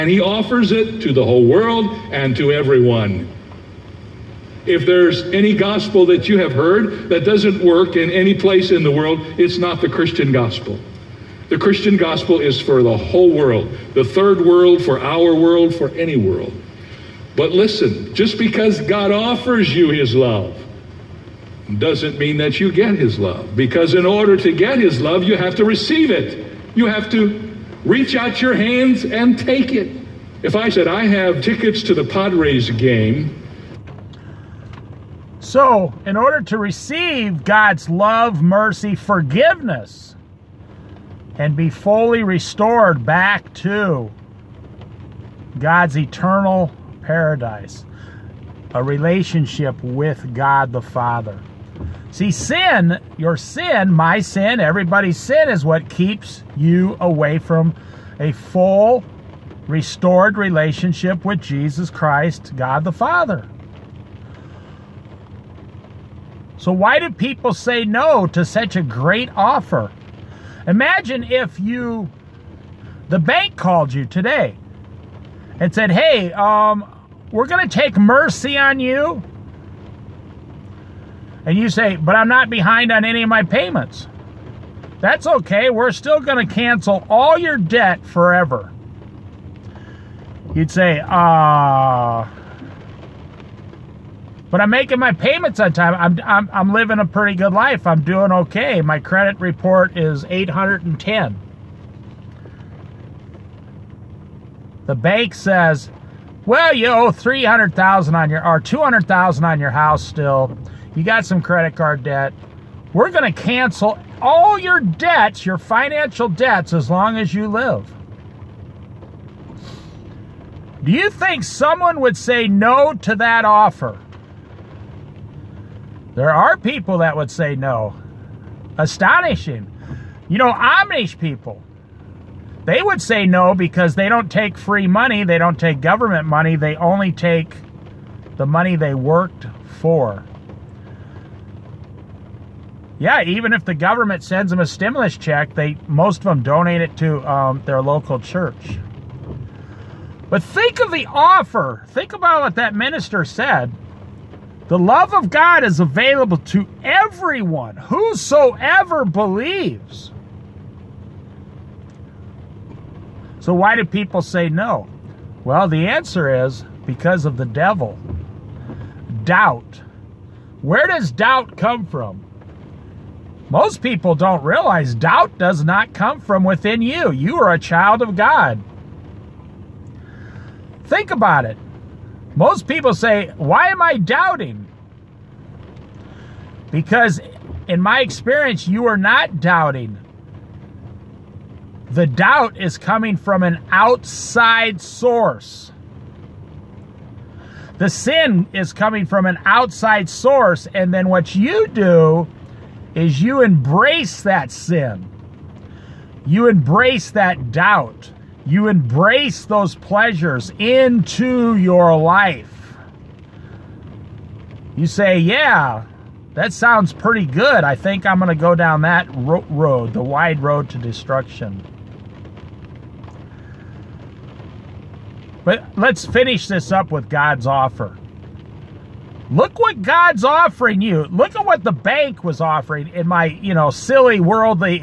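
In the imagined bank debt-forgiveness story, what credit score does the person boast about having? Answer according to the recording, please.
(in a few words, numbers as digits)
810.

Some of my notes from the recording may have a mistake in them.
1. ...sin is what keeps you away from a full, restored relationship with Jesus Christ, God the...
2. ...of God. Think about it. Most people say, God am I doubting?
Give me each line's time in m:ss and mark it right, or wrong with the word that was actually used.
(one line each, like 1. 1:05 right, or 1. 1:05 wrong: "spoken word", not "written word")
1. 0:55 right
2. 2:58 wrong: "Why", not "God".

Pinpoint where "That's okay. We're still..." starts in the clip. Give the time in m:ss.
1:25.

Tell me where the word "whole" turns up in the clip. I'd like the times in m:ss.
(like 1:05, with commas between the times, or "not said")
0:01, 0:12.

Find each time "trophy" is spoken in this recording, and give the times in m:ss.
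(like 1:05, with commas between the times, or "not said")
not said.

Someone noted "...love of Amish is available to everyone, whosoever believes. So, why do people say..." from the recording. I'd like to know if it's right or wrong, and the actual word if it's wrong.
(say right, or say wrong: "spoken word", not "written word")
wrong: "God", not "Amish".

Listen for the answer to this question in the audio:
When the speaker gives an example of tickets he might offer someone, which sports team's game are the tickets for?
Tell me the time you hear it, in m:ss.
0:32.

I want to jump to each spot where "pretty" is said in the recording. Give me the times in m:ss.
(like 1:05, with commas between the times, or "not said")
1:37, 3:36.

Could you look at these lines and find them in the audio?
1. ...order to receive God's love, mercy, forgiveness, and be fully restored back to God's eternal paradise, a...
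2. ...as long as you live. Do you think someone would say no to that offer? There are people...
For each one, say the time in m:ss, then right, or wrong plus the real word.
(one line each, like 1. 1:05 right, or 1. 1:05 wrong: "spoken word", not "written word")
1. 0:36 right
2. 1:56 right.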